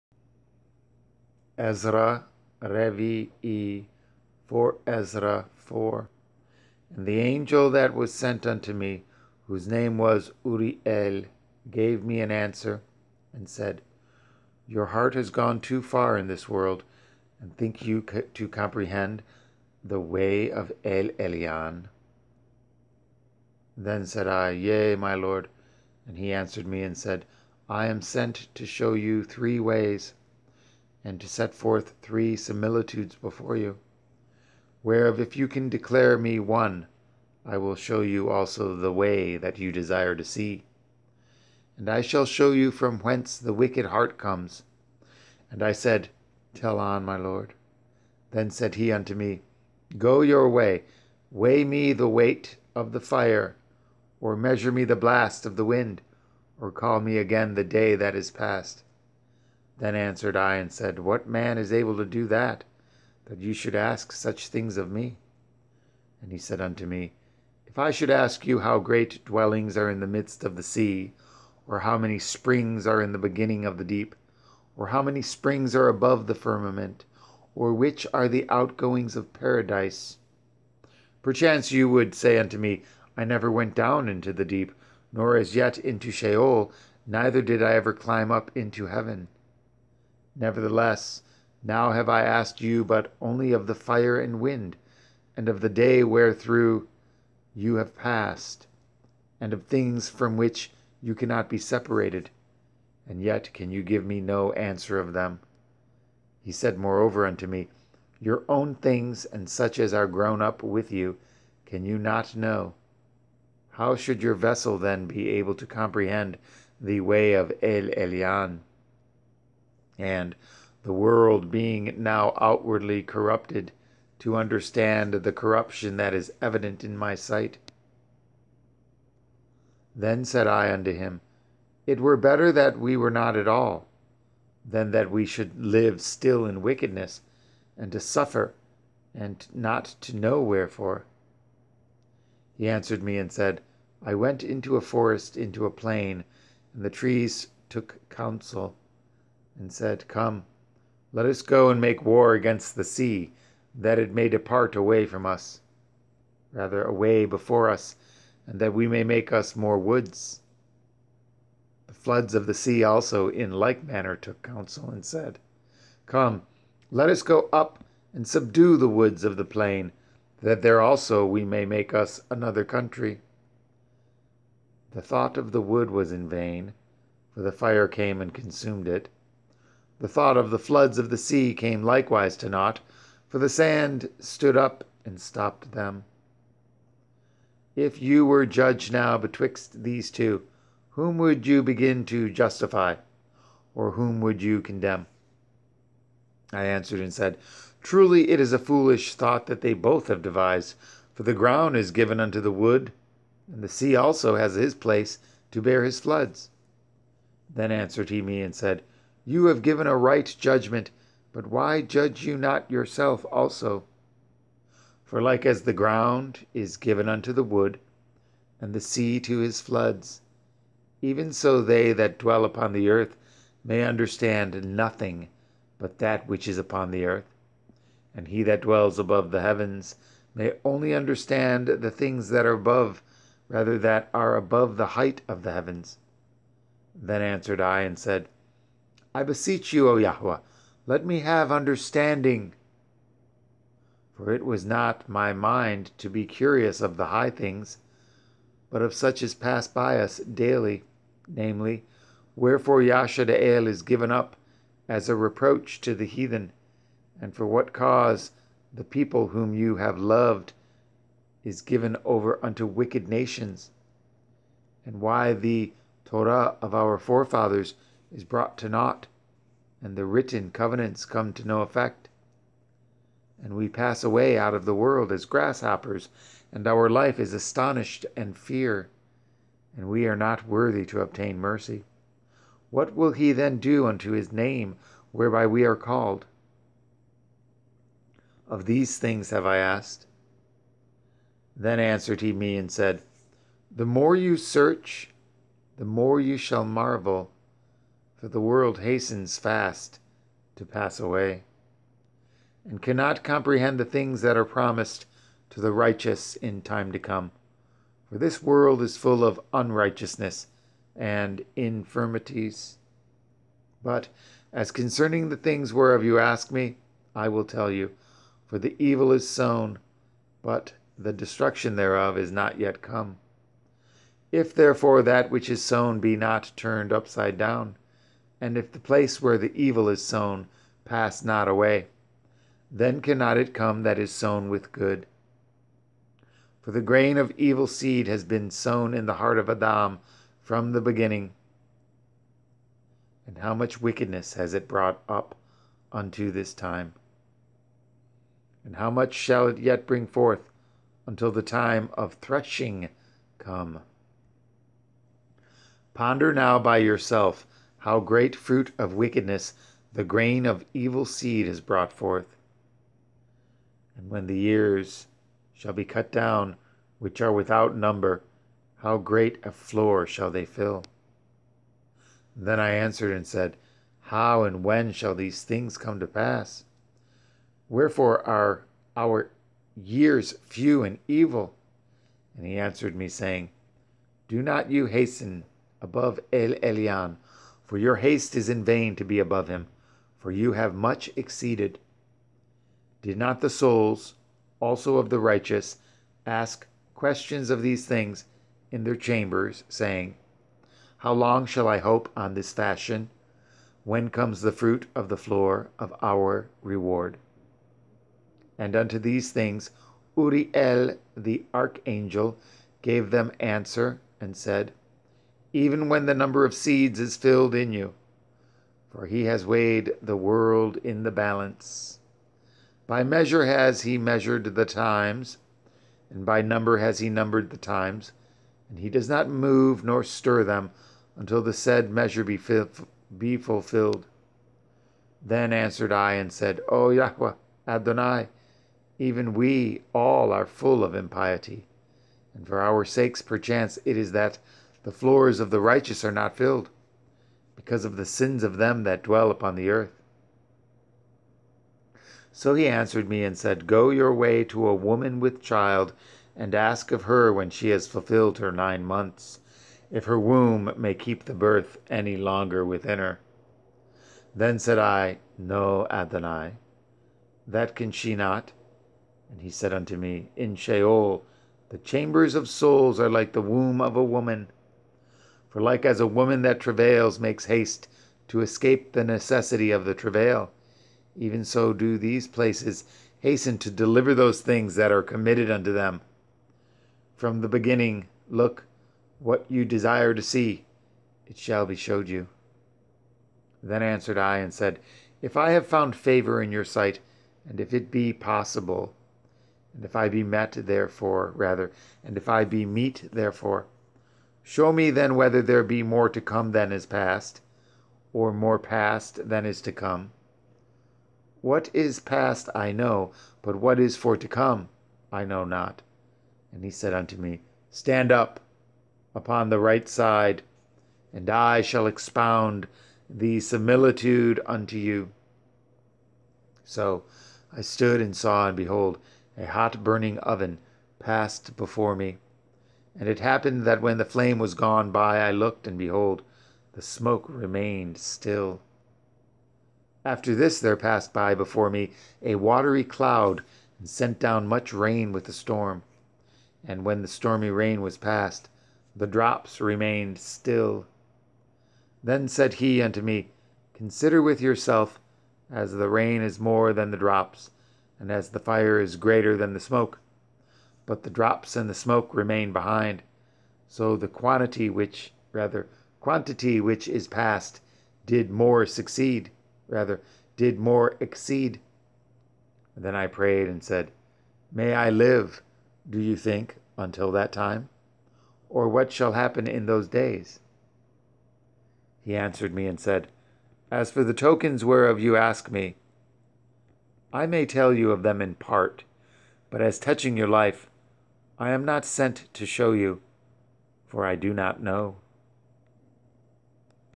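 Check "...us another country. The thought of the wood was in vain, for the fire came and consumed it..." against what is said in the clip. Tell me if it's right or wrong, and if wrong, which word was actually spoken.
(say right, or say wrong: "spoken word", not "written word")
right.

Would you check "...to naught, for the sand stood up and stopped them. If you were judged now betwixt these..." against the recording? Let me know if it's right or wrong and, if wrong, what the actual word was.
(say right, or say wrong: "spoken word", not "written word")
right.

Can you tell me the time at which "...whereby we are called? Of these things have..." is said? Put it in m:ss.
4:45.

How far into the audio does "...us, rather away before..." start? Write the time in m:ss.
2:35.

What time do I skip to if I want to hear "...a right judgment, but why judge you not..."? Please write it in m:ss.
3:29.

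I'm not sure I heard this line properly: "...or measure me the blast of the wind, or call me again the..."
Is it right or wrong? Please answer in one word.
right.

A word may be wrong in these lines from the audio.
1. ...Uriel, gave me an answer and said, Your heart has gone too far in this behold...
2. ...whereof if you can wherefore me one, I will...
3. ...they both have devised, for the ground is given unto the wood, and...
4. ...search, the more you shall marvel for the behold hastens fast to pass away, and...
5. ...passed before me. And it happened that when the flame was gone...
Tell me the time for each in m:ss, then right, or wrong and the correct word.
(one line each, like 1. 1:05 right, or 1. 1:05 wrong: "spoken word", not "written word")
1. 0:10 wrong: "world", not "behold"
2. 0:34 wrong: "declare", not "wherefore"
3. 3:19 right
4. 4:54 wrong: "world", not "behold"
5. 8:50 right.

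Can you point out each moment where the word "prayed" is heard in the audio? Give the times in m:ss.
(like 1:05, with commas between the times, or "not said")
9:33.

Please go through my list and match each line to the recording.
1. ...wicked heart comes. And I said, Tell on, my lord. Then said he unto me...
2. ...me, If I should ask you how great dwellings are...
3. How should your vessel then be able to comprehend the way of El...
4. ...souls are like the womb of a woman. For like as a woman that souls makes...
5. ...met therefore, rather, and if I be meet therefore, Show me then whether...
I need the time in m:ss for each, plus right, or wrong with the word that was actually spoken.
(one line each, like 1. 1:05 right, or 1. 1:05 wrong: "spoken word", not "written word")
1. 0:43 right
2. 1:06 right
3. 1:53 right
4. 7:52 wrong: "travails", not "souls"
5. 8:20 right.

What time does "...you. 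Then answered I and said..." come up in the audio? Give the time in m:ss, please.
8:12.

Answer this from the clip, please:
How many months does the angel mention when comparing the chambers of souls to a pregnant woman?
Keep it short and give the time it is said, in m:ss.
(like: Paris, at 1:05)
9, at 7:38.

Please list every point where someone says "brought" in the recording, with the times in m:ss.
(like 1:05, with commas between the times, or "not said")
4:28, 5:44, 6:01.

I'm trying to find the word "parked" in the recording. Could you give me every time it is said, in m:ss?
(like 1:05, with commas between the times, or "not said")
not said.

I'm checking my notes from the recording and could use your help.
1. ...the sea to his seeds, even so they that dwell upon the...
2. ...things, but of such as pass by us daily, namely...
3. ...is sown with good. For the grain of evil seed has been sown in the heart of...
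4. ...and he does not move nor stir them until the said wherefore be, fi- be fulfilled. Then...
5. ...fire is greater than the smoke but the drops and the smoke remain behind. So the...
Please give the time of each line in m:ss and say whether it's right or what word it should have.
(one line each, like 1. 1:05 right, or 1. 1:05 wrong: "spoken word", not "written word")
1. 3:38 wrong: "floods", not "seeds"
2. 4:07 right
3. 5:33 right
4. 7:08 wrong: "measure", not "wherefore"
5. 9:18 right.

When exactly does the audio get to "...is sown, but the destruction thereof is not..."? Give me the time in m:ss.
5:19.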